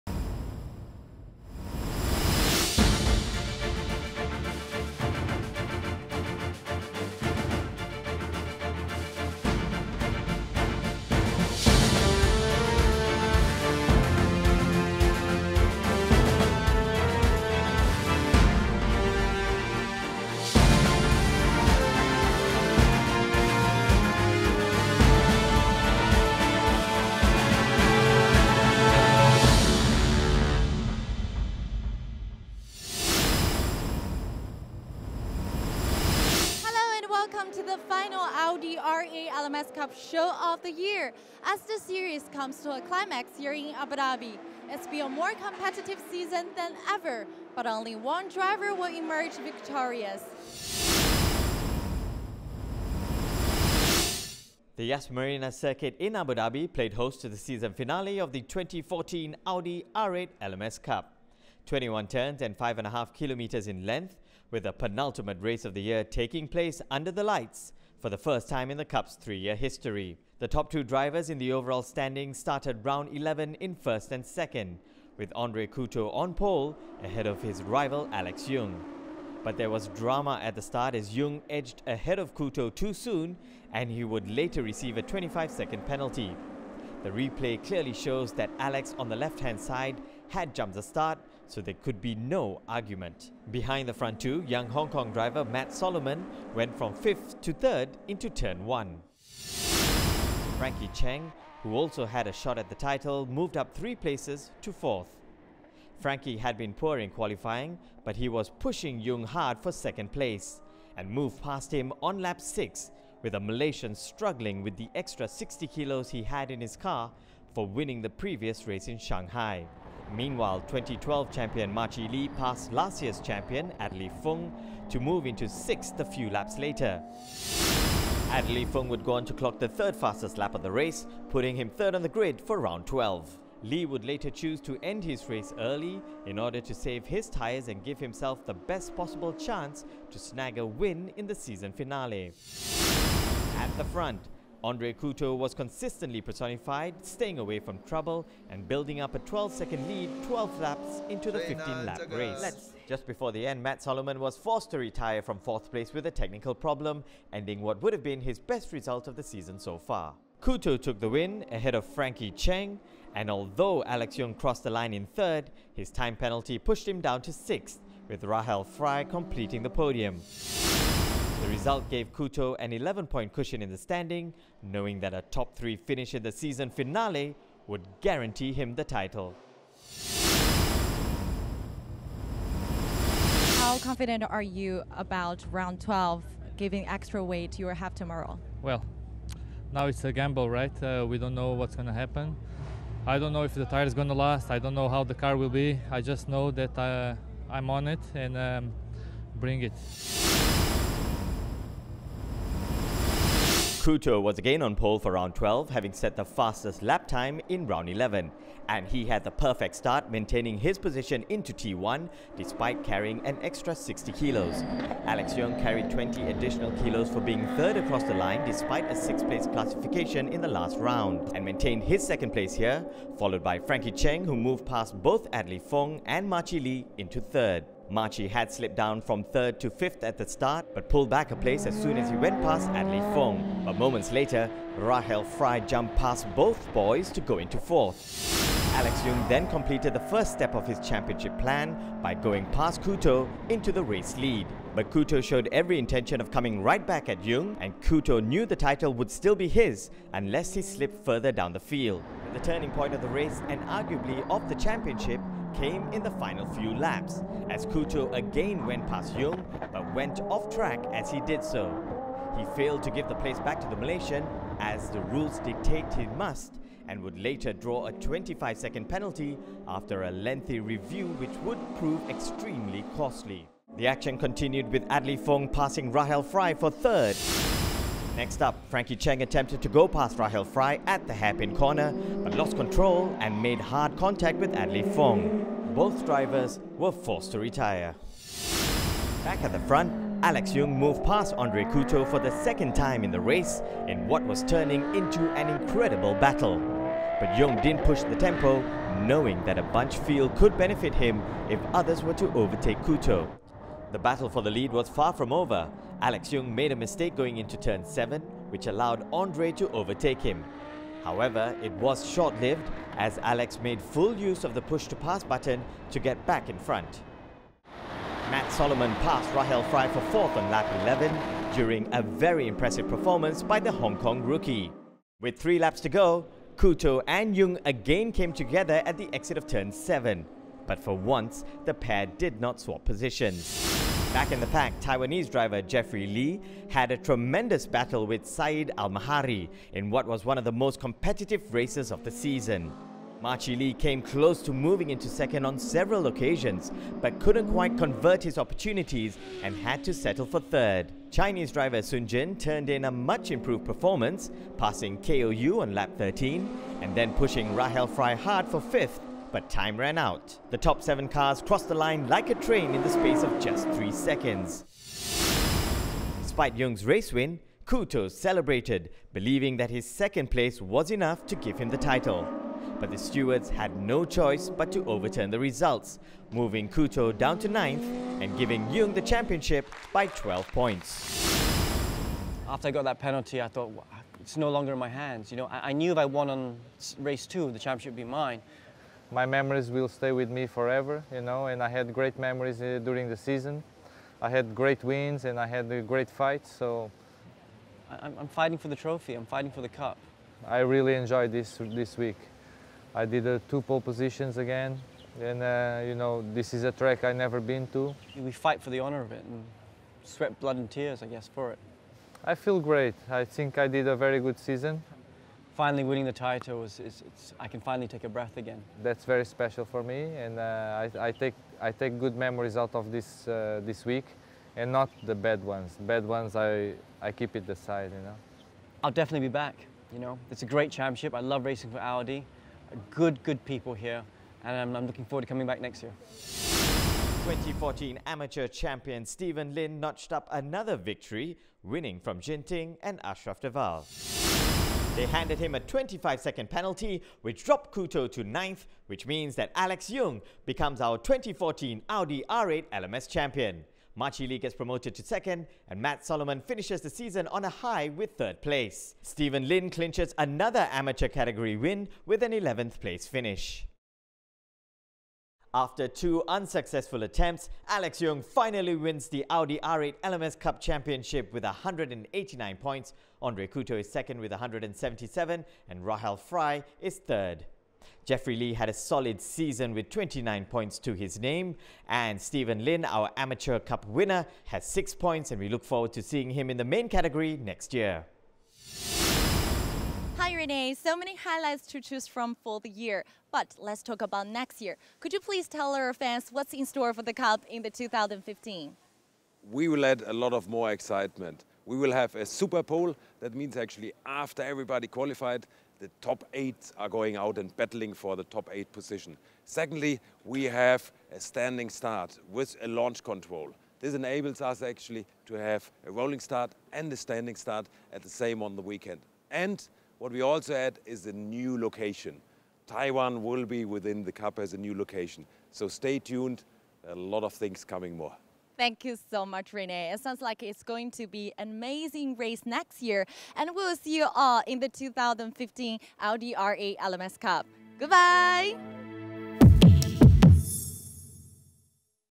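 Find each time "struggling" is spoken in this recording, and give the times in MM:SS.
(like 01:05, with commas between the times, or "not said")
01:53.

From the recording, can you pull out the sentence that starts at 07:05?
Bad ones I I keep it aside, you know.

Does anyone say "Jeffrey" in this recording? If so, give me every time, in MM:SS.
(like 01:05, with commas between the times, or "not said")
05:35, 07:58.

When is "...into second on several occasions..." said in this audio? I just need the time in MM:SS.
05:44.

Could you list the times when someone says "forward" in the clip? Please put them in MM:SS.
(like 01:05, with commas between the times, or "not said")
07:15, 08:05.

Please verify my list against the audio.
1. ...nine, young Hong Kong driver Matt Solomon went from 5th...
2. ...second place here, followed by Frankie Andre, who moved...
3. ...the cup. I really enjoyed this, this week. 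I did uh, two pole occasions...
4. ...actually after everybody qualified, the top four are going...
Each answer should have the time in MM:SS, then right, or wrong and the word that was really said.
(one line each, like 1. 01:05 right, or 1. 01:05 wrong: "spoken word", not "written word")
1. 01:34 wrong: "two", not "nine"
2. 03:42 wrong: "Cheng", not "Andre"
3. 06:39 wrong: "positions", not "occasions"
4. 08:23 wrong: "eight", not "four".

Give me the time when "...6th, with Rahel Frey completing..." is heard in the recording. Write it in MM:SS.
02:47.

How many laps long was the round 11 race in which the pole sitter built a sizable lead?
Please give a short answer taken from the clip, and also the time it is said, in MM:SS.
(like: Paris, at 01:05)
15, at 02:31.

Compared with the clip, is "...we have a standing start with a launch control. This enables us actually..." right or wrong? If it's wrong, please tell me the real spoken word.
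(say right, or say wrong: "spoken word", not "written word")
right.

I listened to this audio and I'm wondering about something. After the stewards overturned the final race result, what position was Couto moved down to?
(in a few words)
9th.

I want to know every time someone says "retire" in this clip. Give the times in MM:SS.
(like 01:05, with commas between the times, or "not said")
02:34, 04:47.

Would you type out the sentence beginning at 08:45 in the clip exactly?
So stay tuned, a lot of things coming more.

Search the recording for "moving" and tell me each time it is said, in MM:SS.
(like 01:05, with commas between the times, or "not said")
05:44, 06:16.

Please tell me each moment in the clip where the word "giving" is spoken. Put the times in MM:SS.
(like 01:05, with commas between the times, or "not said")
03:06, 06:18.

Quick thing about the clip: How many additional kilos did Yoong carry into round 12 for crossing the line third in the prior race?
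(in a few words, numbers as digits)
20.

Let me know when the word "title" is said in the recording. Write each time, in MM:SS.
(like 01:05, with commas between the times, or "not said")
01:42, 02:58, 04:08, 06:11, 06:56.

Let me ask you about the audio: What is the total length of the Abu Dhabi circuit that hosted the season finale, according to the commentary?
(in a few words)
5.5 kilometers.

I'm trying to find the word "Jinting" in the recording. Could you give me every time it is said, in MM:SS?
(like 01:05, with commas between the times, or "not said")
07:22.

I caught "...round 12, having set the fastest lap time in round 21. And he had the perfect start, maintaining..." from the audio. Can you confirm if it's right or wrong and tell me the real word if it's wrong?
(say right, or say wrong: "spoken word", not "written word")
wrong: "11", not "21".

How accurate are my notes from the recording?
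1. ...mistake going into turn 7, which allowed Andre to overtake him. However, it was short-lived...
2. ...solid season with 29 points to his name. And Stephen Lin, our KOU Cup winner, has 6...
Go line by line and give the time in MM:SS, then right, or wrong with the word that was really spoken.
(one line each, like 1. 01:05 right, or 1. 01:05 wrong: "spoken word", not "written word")
1. 05:06 right
2. 07:58 wrong: "Amateur", not "KOU".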